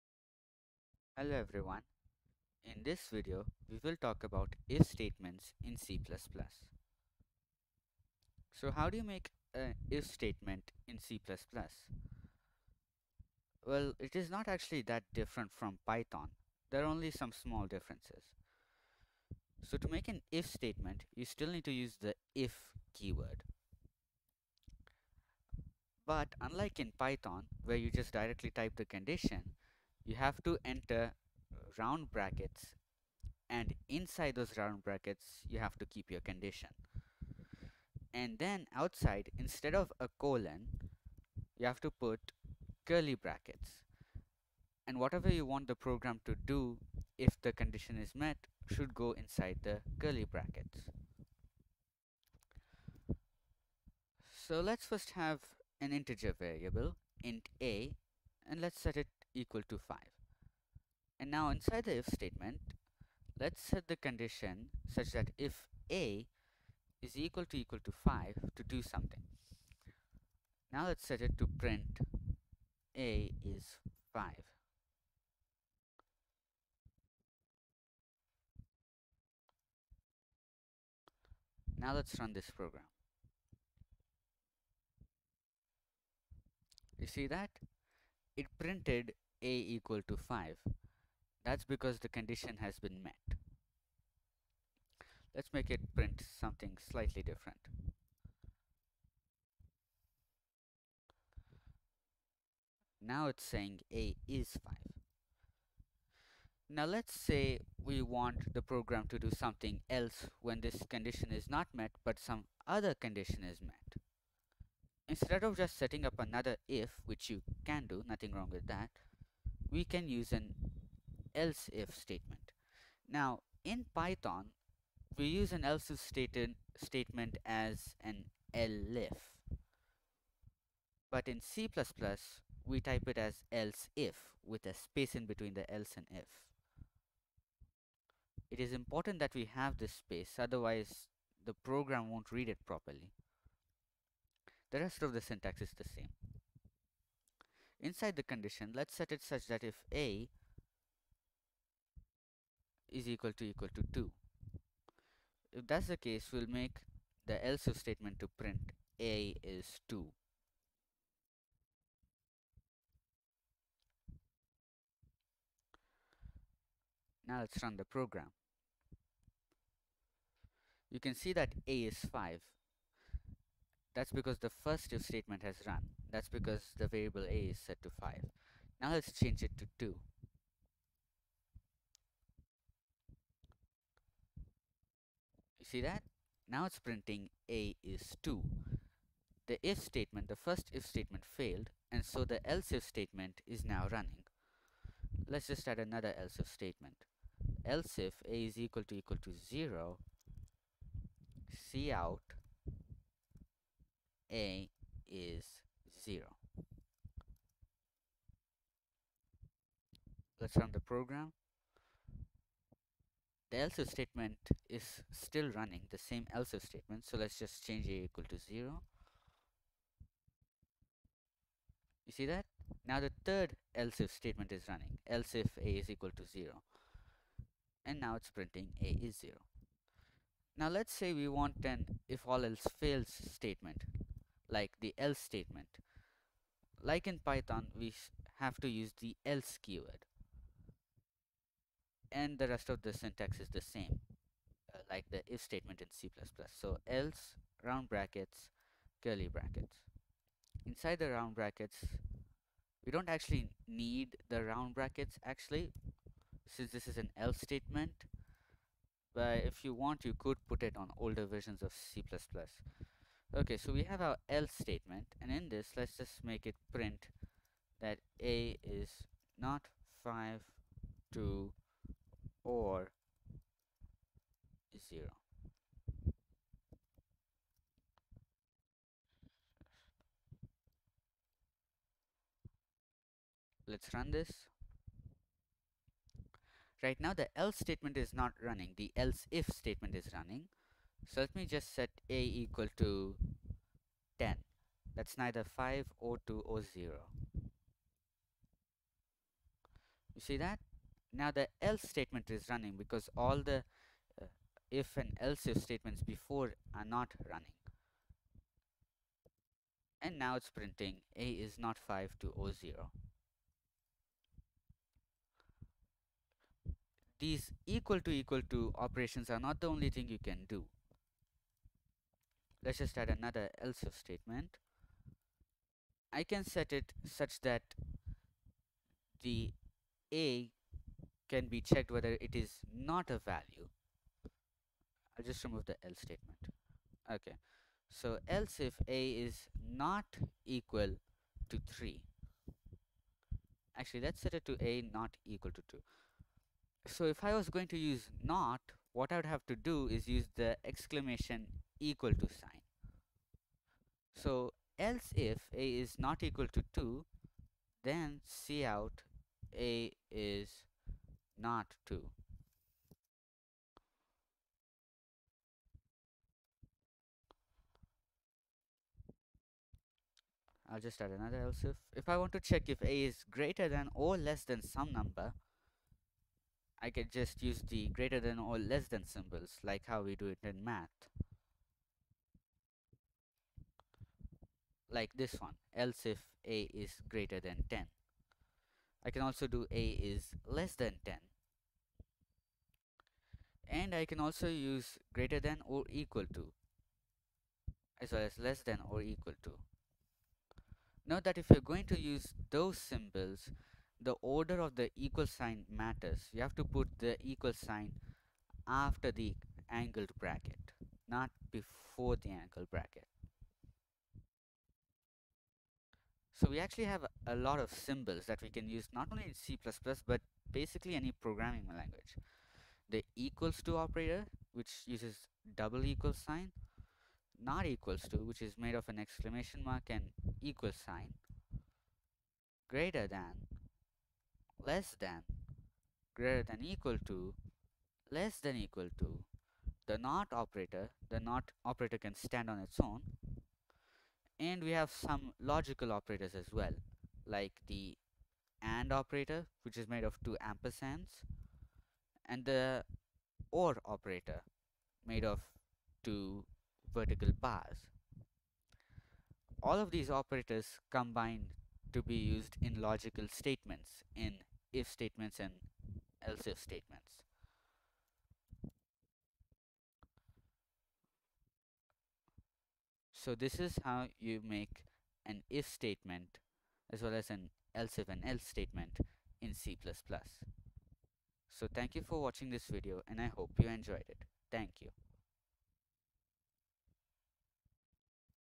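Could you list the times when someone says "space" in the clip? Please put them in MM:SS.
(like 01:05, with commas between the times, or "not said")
02:14, 02:19.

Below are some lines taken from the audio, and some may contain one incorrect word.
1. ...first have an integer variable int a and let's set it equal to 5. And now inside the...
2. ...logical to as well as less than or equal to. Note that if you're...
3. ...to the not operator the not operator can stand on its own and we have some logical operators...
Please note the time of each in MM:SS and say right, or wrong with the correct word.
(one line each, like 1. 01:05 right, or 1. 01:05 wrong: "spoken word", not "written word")
1. 00:54 right
2. 06:35 wrong: "equal", not "logical"
3. 07:18 right.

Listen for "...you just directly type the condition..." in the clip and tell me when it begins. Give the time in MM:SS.
00:27.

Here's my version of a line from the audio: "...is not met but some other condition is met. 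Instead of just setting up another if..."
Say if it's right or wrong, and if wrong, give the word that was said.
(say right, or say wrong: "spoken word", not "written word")
right.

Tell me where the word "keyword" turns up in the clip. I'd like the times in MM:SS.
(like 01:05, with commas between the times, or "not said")
00:22, 03:59.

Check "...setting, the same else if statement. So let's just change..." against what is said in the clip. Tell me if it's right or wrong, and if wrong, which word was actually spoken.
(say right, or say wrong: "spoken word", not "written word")
wrong: "running", not "setting".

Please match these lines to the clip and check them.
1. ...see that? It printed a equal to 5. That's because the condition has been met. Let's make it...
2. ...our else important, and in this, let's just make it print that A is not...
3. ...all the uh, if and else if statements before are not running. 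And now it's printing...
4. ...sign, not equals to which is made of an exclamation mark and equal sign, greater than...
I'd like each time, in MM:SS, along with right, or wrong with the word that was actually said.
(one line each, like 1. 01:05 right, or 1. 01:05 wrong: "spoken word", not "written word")
1. 01:27 right
2. 04:24 wrong: "statement", not "important"
3. 05:03 right
4. 07:06 right.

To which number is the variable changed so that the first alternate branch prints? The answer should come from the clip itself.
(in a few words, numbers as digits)
2.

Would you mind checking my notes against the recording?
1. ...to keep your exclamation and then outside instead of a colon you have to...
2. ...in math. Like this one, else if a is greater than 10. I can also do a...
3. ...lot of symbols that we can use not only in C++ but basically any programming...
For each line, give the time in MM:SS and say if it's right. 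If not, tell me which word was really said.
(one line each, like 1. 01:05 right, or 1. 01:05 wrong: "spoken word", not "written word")
1. 00:35 wrong: "condition", not "exclamation"
2. 06:20 right
3. 06:57 right.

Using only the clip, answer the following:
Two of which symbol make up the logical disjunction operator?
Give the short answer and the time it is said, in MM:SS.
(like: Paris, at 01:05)
vertical bars, at 07:36.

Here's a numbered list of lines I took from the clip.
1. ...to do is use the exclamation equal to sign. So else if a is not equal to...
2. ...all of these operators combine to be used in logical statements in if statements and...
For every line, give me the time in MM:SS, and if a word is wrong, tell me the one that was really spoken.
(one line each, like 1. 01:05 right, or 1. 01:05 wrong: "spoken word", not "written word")
1. 05:49 right
2. 07:39 right.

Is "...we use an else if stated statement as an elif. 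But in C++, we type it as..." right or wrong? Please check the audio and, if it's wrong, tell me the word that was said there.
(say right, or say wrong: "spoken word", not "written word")
right.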